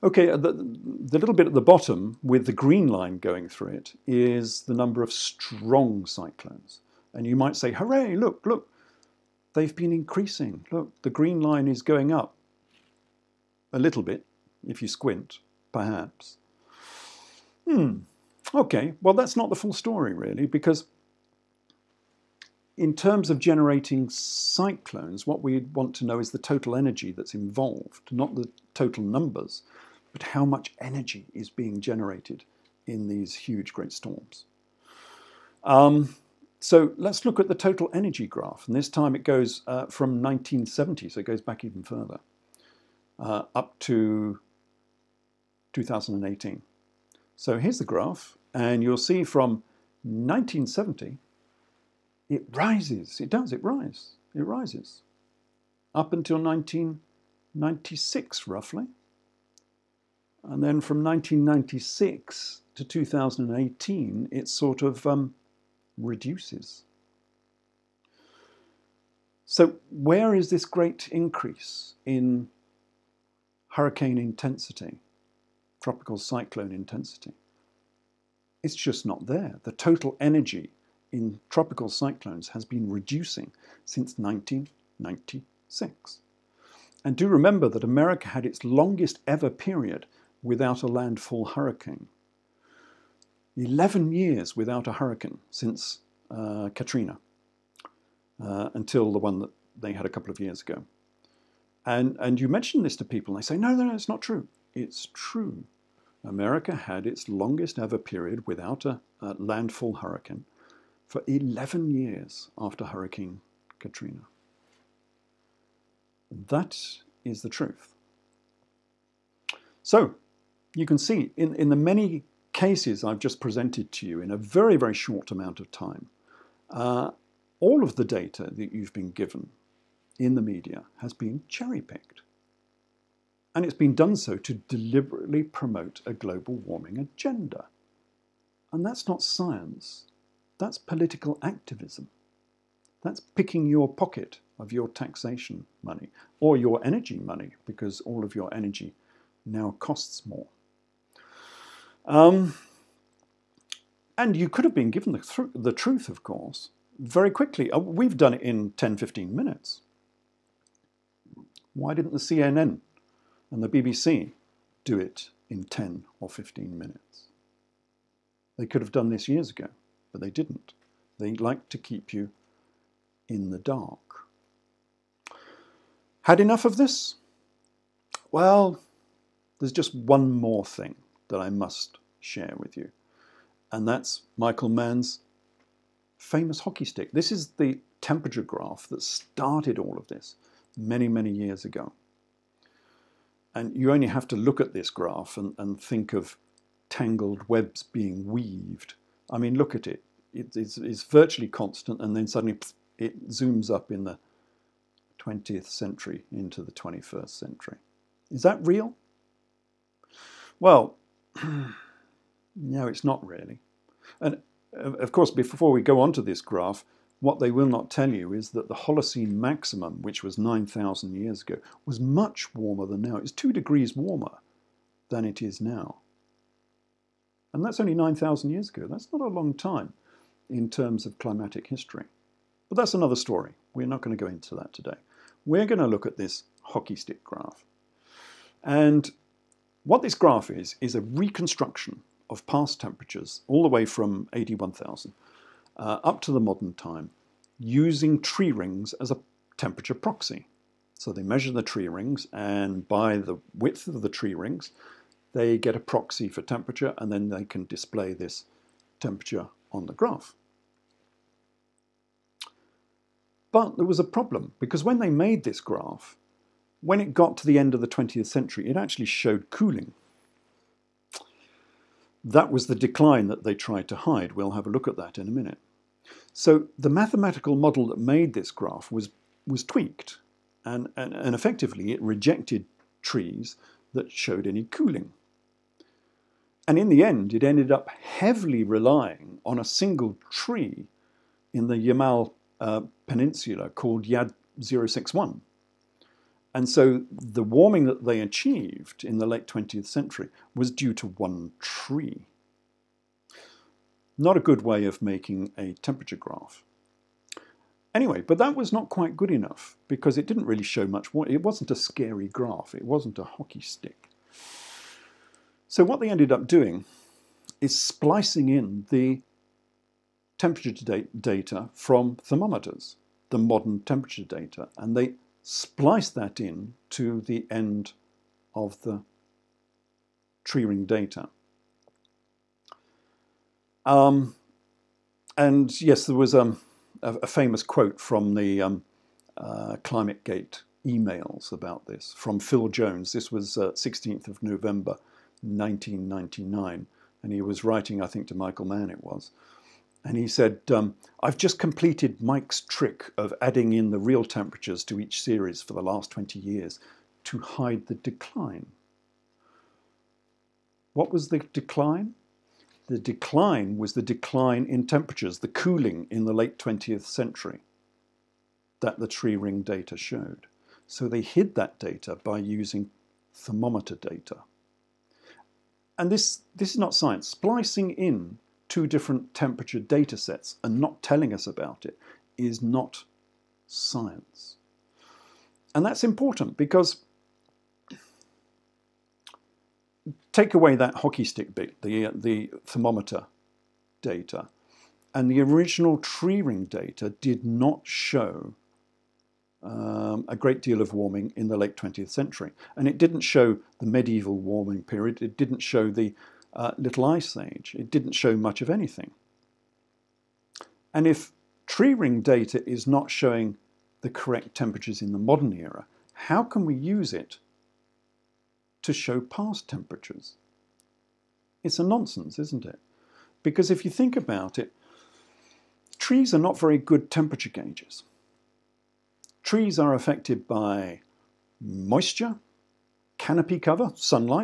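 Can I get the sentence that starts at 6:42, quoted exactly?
And it didn't show the medieval warming period, it didn't show the uh, Little Ice Age.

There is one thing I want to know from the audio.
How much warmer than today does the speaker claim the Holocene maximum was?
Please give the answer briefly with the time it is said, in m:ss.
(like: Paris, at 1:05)
2 degrees, at 3:43.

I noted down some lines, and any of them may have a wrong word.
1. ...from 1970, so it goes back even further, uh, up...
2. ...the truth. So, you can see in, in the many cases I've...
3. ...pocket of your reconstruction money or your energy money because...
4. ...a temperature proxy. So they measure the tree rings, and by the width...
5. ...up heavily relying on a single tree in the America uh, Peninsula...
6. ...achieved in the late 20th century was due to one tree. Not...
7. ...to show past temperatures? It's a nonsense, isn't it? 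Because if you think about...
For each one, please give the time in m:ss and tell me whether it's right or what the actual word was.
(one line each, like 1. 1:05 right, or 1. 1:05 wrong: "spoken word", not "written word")
1. 0:39 right
2. 1:57 right
3. 2:23 wrong: "taxation", not "reconstruction"
4. 4:09 right
5. 4:47 wrong: "Yamal", not "America"
6. 4:58 right
7. 6:58 right.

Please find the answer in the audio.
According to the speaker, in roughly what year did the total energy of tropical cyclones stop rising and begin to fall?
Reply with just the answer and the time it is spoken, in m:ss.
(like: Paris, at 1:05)
1996, at 0:55.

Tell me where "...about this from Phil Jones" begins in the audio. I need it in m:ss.
5:41.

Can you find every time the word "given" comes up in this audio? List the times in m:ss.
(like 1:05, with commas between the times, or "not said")
2:09, 2:34.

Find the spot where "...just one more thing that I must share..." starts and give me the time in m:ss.
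2:59.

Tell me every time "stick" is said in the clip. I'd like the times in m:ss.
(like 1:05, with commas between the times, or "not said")
3:06, 3:56, 5:13, 6:31.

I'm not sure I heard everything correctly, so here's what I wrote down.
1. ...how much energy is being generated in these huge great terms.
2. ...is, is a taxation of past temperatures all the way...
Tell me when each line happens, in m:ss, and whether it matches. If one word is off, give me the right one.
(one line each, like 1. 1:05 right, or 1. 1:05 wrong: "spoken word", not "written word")
1. 0:30 wrong: "storms", not "terms"
2. 4:00 wrong: "reconstruction", not "taxation".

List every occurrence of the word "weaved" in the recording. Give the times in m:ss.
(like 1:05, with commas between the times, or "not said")
3:18.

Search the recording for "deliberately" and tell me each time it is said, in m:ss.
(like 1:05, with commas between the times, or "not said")
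2:14.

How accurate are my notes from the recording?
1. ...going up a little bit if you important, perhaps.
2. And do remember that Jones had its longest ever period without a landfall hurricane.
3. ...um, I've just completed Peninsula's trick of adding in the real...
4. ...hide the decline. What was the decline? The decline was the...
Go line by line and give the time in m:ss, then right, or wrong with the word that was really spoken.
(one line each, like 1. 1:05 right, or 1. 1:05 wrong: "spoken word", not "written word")
1. 0:11 wrong: "squint", not "important"
2. 1:27 wrong: "America", not "Jones"
3. 5:50 wrong: "Mike", not "Peninsula"
4. 5:57 right.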